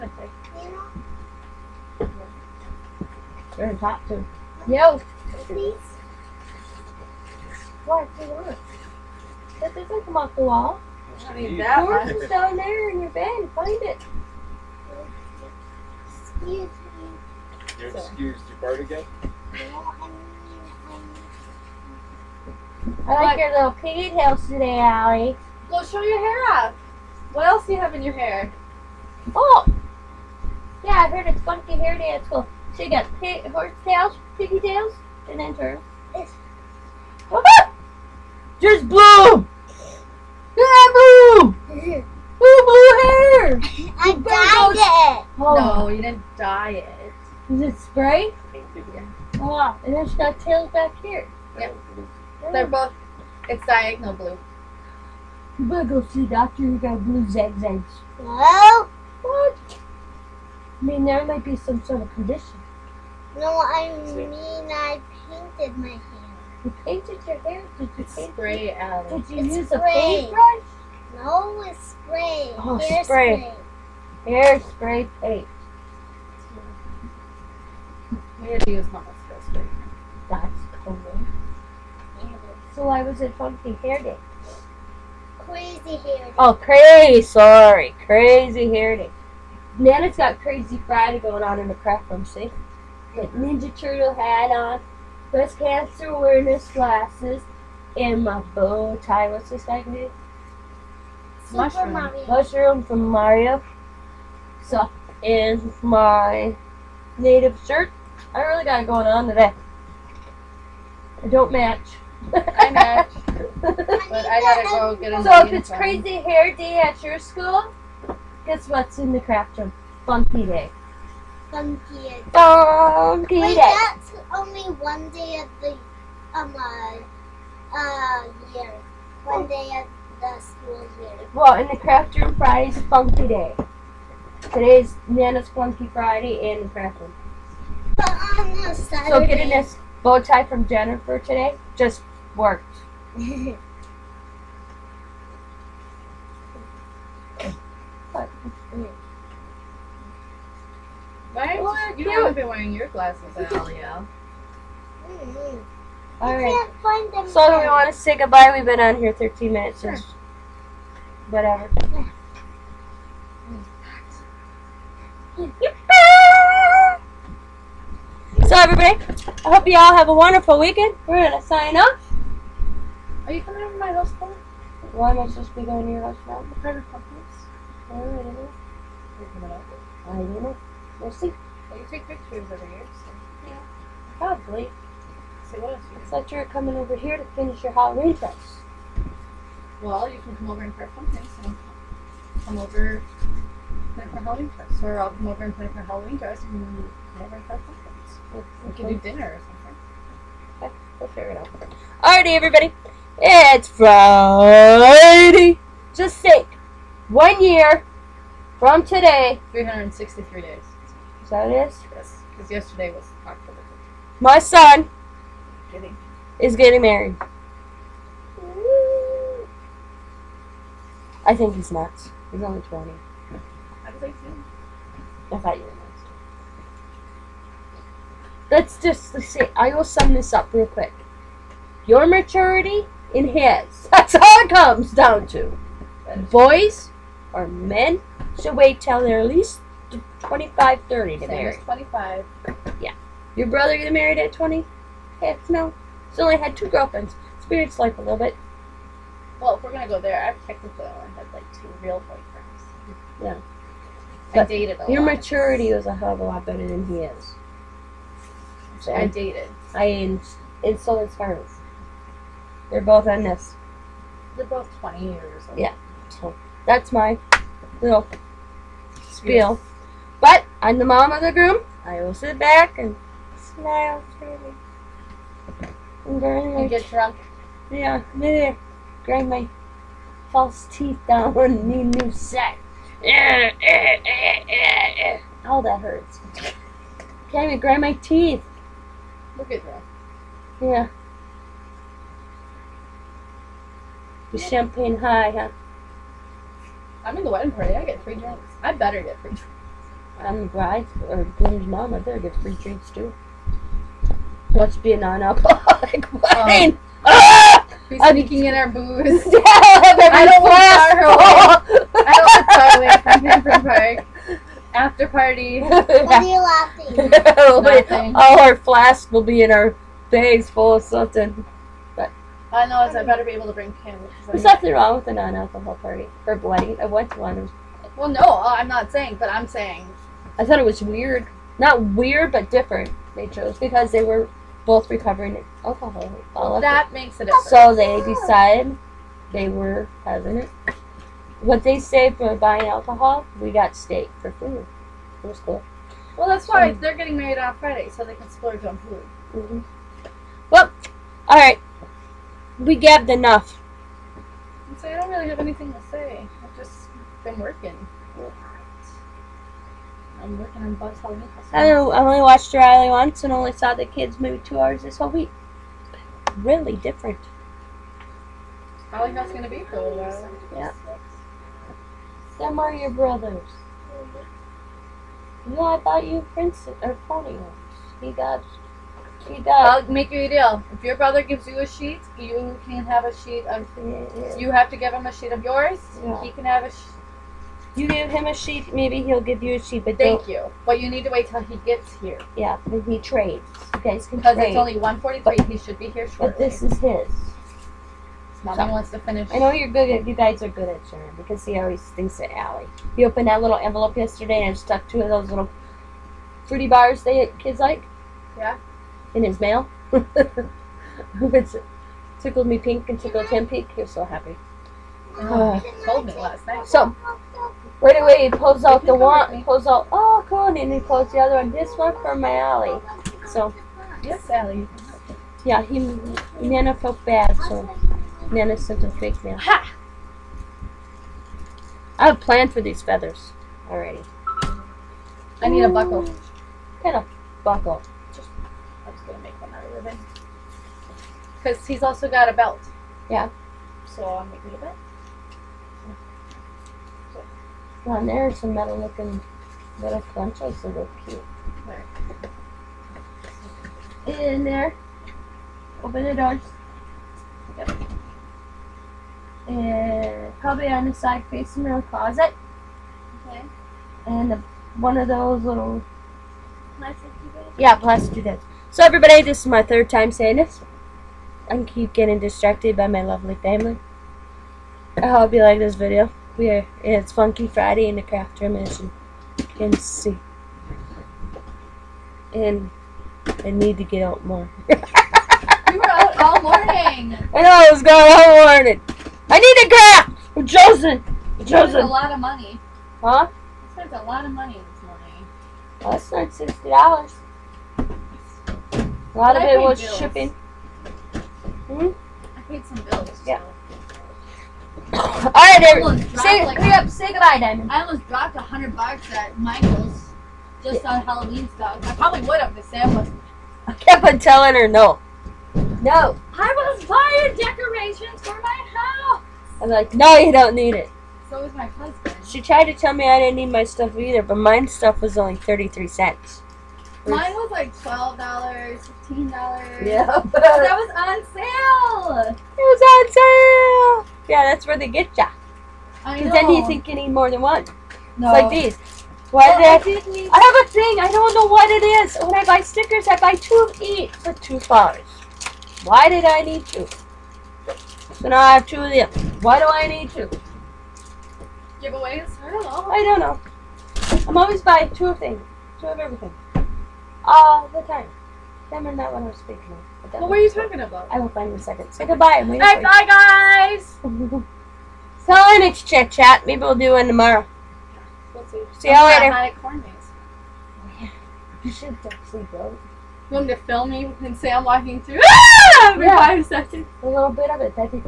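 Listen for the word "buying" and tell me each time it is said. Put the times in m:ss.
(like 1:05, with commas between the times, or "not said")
5:42, 8:36, 9:14.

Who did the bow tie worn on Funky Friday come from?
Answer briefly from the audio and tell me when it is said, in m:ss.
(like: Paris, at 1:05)
Jennifer, at 2:20.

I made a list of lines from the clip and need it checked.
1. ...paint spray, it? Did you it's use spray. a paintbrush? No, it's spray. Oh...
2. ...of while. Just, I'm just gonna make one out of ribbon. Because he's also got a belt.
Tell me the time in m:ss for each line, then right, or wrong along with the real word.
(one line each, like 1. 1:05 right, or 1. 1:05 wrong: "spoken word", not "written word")
1. 1:08 right
2. 7:16 wrong: "buckle", not "while".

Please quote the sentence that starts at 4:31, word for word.
I will sit back and smile freely and grind my.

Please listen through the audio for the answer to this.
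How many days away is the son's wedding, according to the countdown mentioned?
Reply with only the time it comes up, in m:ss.
3:29.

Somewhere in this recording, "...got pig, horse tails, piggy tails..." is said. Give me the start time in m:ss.
0:32.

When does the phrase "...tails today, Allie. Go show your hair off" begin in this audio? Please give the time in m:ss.
0:24.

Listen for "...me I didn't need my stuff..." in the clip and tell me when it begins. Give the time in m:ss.
8:42.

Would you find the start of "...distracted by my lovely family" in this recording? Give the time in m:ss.
7:52.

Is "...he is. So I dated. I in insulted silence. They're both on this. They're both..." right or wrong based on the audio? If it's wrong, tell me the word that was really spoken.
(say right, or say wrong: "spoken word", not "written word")
right.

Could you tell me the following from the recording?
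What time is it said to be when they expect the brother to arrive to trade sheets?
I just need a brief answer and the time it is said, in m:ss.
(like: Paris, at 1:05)
1:43, at 6:34.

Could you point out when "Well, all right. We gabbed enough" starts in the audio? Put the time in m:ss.
5:50.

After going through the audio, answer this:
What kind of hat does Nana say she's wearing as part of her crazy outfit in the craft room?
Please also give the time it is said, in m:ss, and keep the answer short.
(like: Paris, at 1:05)
Ninja Turtle hat, at 1:33.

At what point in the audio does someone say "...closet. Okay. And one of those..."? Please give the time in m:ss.
7:41.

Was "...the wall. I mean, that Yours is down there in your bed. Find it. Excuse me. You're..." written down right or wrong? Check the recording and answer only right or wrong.
right.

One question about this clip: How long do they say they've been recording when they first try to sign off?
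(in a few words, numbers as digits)
13 minutes.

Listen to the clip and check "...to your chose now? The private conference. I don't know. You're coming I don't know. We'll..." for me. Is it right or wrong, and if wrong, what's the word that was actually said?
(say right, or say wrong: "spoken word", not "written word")
wrong: "house", not "chose".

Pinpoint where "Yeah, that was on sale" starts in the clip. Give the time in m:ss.
8:49.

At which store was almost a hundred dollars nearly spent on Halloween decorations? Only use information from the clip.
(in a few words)
Michael's.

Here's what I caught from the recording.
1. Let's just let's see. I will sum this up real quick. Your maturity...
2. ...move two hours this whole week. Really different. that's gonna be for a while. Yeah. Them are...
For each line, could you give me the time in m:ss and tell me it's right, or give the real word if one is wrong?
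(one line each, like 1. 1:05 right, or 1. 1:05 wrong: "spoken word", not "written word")
1. 3:48 right
2. 6:04 right.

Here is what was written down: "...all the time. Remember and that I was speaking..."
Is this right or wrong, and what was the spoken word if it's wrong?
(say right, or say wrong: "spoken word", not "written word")
right.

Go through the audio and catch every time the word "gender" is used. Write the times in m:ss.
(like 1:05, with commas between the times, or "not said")
not said.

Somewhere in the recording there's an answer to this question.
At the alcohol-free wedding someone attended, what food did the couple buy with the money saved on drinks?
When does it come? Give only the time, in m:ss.
5:43.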